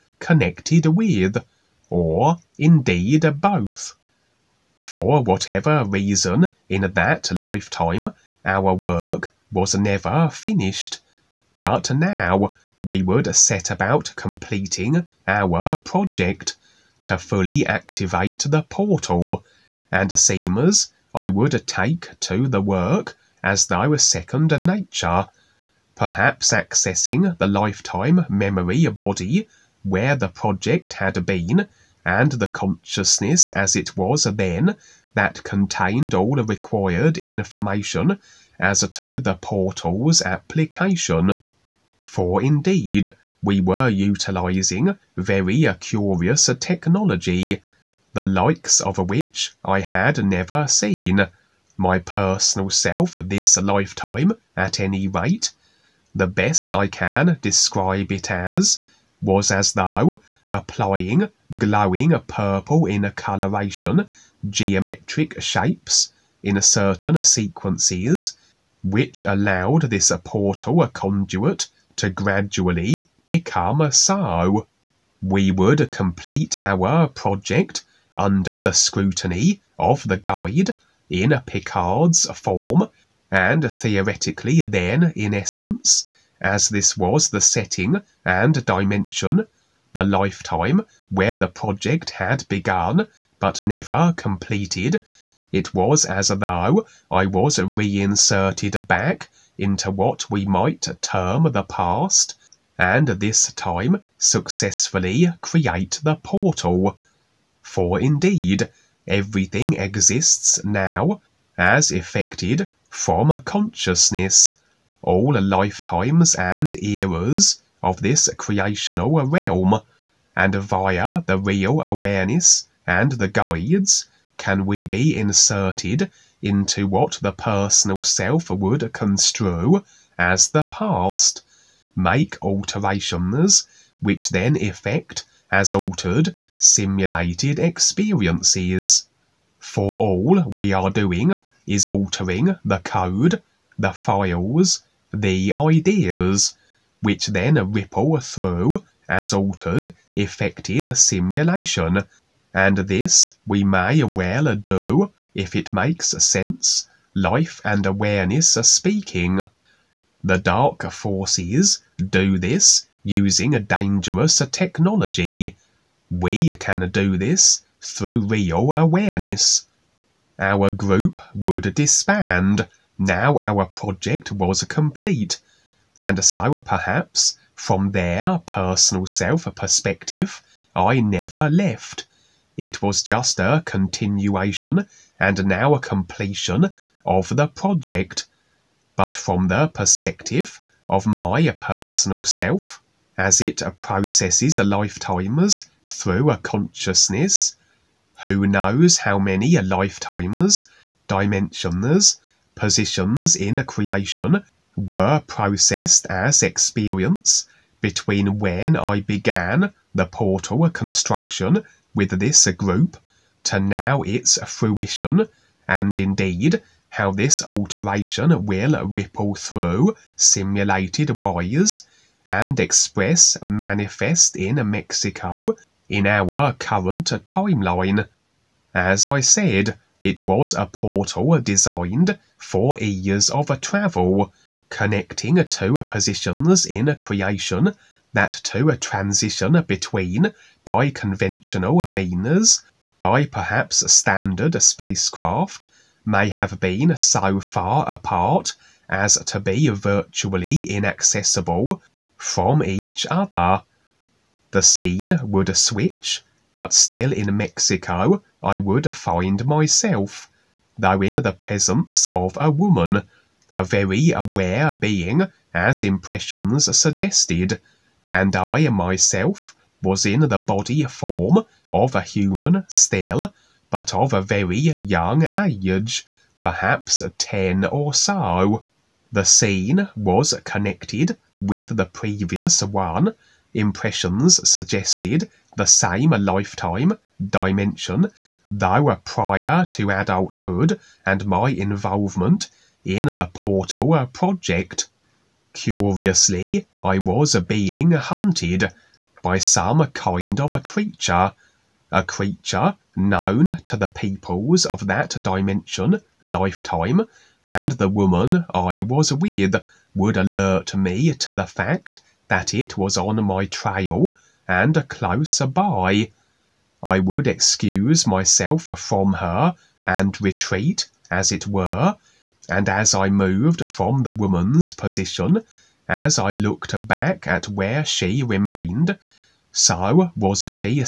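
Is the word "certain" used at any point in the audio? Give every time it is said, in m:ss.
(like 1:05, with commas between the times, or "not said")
1:06.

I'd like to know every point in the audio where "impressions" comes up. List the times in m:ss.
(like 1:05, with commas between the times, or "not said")
4:25, 4:43.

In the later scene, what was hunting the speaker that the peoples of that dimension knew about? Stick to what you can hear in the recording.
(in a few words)
A creature.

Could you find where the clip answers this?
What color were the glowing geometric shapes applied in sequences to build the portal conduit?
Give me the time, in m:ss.
1:02.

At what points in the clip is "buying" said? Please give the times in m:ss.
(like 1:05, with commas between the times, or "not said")
not said.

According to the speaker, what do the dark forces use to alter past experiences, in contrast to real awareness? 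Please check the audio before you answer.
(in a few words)
A dangerous technology.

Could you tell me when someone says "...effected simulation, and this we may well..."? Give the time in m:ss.
2:30.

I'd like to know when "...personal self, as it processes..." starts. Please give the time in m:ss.
3:11.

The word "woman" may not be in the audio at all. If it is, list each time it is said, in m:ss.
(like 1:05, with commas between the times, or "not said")
4:22, 5:07, 5:24.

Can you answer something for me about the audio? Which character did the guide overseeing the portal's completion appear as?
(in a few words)
Picard.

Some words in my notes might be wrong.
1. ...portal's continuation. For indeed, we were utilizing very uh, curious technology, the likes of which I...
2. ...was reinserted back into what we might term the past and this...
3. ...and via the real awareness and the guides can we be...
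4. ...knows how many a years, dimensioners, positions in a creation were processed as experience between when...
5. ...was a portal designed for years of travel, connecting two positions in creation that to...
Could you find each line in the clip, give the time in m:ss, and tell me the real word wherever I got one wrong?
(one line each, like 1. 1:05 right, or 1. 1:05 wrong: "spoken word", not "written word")
1. 0:39 wrong: "application", not "continuation"
2. 1:37 right
3. 2:00 right
4. 3:18 wrong: "lifetimers", not "years"
5. 3:50 right.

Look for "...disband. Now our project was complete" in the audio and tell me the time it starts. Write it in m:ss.
2:51.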